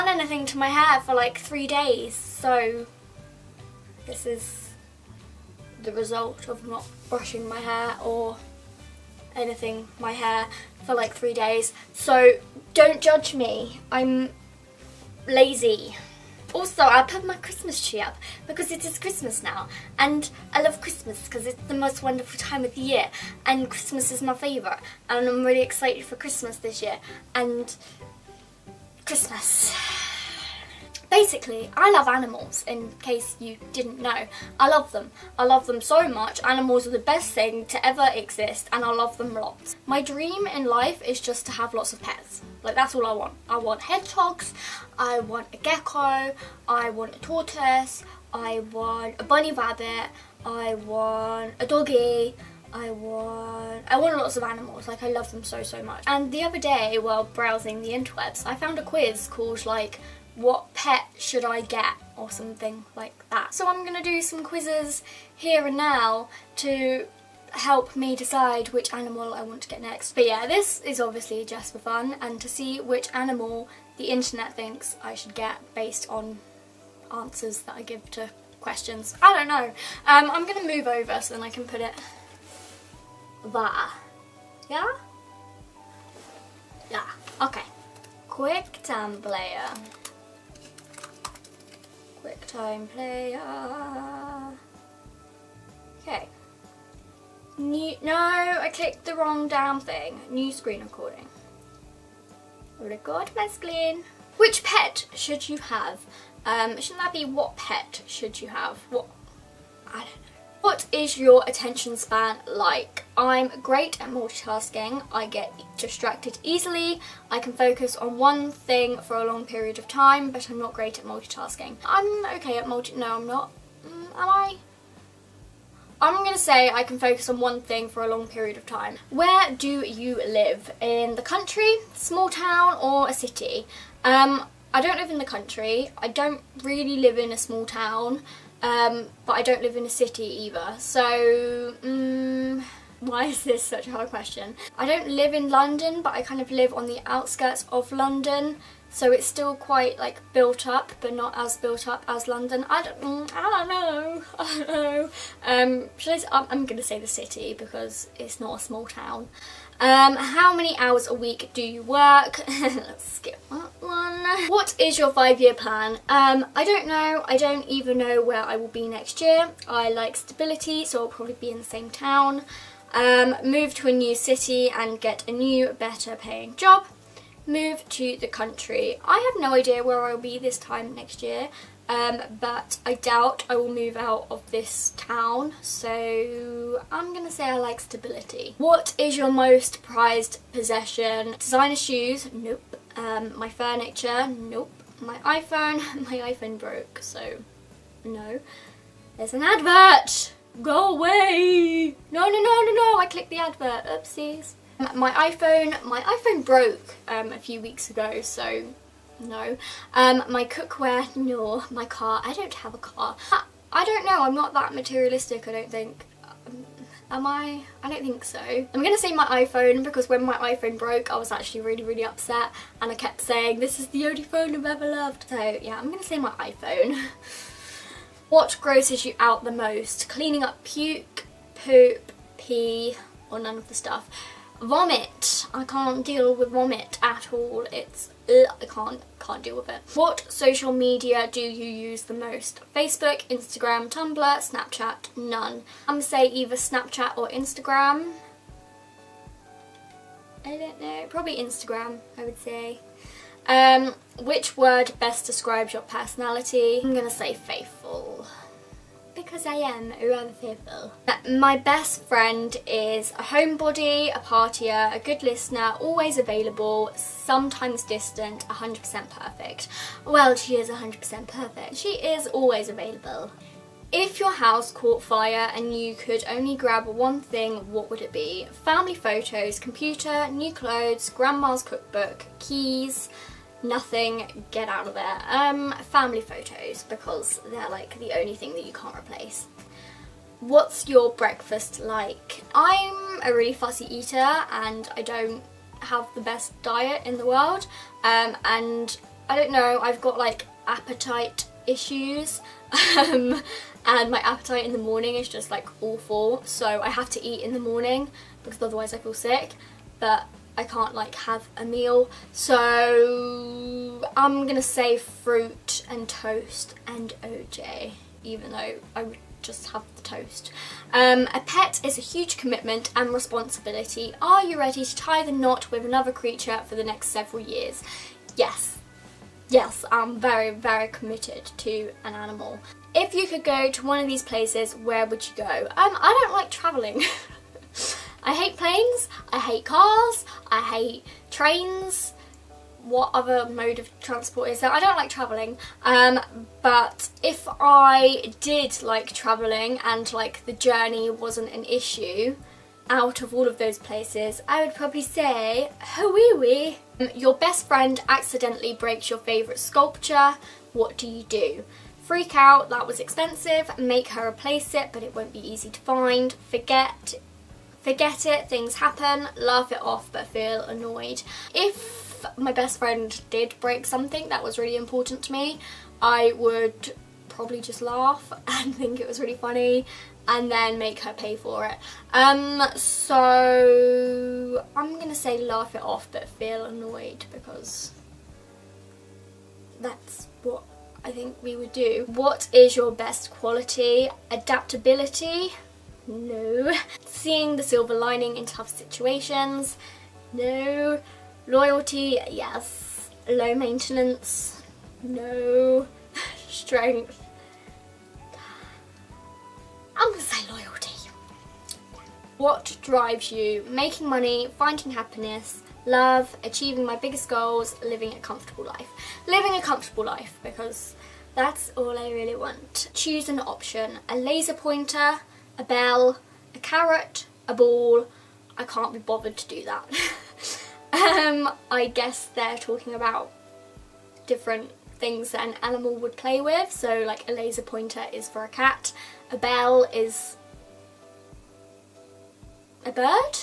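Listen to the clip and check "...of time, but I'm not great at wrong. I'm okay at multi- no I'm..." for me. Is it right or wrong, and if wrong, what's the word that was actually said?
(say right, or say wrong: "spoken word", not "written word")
wrong: "multitasking", not "wrong".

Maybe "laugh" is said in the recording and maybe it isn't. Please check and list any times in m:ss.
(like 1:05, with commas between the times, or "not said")
6:09, 6:17, 6:25.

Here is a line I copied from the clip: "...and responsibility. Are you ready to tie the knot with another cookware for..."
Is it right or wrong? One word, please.
wrong.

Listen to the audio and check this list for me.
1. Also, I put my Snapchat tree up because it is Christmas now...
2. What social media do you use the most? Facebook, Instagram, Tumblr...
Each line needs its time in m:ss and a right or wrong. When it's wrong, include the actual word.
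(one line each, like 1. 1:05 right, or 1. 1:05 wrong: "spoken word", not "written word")
1. 0:16 wrong: "Christmas", not "Snapchat"
2. 3:59 right.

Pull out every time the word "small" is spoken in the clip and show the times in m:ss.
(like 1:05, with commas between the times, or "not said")
2:11, 2:17, 2:38.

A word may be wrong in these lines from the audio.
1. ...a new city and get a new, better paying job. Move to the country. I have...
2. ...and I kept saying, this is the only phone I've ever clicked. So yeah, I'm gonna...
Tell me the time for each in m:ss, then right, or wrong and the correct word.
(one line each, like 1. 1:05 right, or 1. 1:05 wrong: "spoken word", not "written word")
1. 2:53 right
2. 3:42 wrong: "loved", not "clicked".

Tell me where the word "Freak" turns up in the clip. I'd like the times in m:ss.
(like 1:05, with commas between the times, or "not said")
6:02.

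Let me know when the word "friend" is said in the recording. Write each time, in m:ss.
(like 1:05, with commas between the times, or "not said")
4:22, 5:57, 6:12.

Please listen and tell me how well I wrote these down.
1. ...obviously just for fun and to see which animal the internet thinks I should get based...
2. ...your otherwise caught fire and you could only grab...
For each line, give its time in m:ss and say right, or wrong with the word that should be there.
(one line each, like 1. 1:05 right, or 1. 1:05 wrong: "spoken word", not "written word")
1. 1:10 right
2. 4:34 wrong: "house", not "otherwise".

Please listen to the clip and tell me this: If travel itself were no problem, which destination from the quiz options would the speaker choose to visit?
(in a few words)
Hawaii.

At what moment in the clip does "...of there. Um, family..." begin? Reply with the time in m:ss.
4:44.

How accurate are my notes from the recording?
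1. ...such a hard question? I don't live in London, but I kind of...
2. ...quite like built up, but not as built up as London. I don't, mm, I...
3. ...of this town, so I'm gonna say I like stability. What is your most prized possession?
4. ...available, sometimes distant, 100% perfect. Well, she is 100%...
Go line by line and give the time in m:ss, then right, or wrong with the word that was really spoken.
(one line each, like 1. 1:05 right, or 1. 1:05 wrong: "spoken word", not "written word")
1. 2:23 right
2. 2:29 right
3. 3:04 right
4. 4:26 right.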